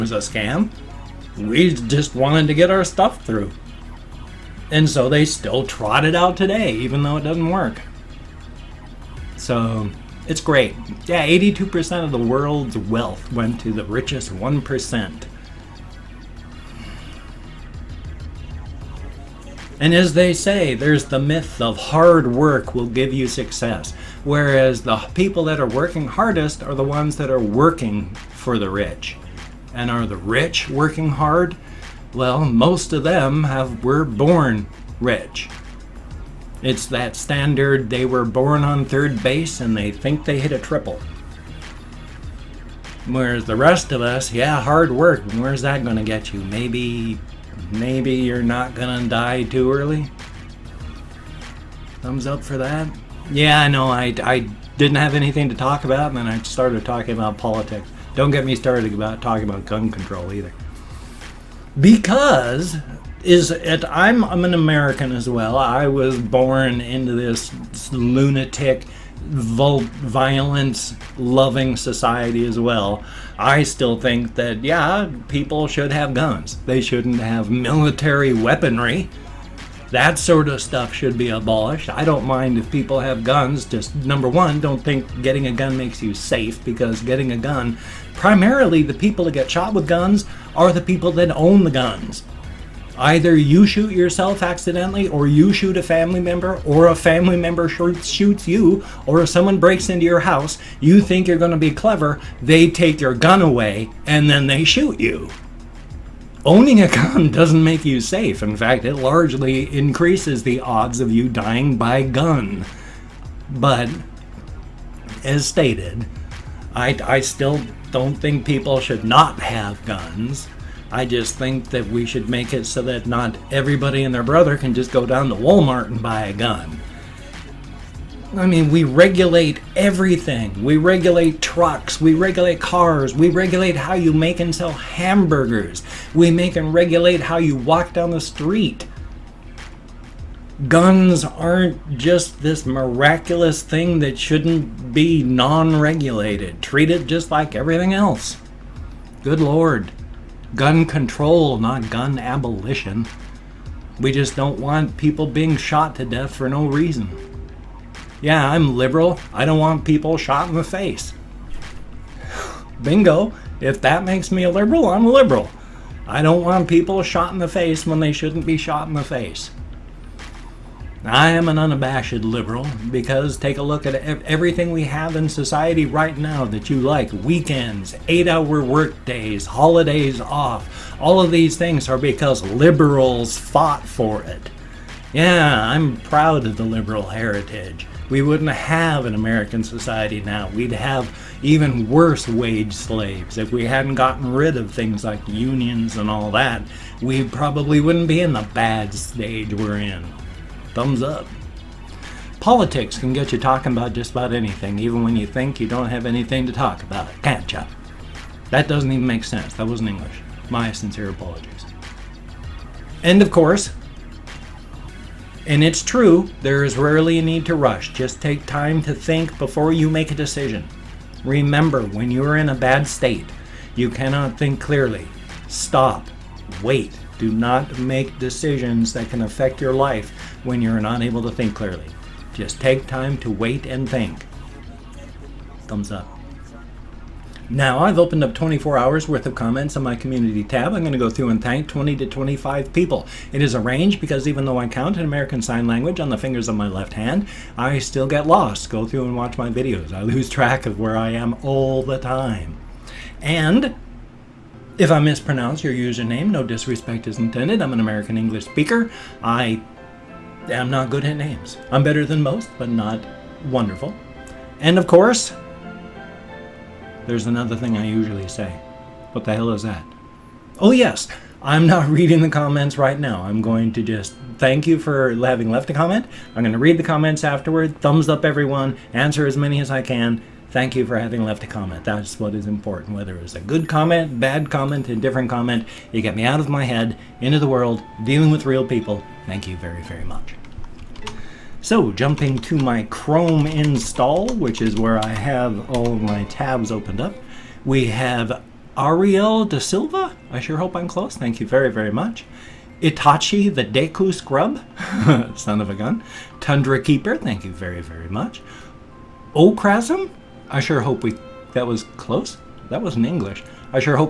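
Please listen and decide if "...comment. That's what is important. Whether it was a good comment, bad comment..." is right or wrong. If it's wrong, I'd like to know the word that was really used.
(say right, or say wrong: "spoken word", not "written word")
right.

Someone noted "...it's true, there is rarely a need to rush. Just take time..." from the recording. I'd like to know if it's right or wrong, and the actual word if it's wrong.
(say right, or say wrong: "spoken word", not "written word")
right.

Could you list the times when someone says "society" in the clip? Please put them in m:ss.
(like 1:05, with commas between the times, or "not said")
1:11, 2:55, 3:09.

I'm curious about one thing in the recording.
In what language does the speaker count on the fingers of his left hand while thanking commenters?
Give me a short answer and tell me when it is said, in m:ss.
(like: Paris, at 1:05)
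American Sign Language, at 4:05.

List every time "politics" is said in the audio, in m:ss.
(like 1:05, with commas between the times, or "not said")
0:57, 3:22.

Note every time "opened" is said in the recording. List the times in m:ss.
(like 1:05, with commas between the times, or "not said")
3:57, 4:56.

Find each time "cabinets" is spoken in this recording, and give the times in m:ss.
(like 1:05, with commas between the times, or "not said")
not said.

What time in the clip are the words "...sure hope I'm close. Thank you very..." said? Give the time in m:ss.
5:00.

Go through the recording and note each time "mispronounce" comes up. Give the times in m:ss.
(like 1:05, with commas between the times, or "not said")
4:14.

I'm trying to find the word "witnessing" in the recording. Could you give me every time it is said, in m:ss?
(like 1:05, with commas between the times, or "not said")
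not said.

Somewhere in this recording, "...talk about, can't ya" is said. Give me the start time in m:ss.
3:26.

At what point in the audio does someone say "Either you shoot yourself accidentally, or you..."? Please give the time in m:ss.
1:32.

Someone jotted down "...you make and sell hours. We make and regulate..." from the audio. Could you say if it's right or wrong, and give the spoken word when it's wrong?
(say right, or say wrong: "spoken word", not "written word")
wrong: "hamburgers", not "hours".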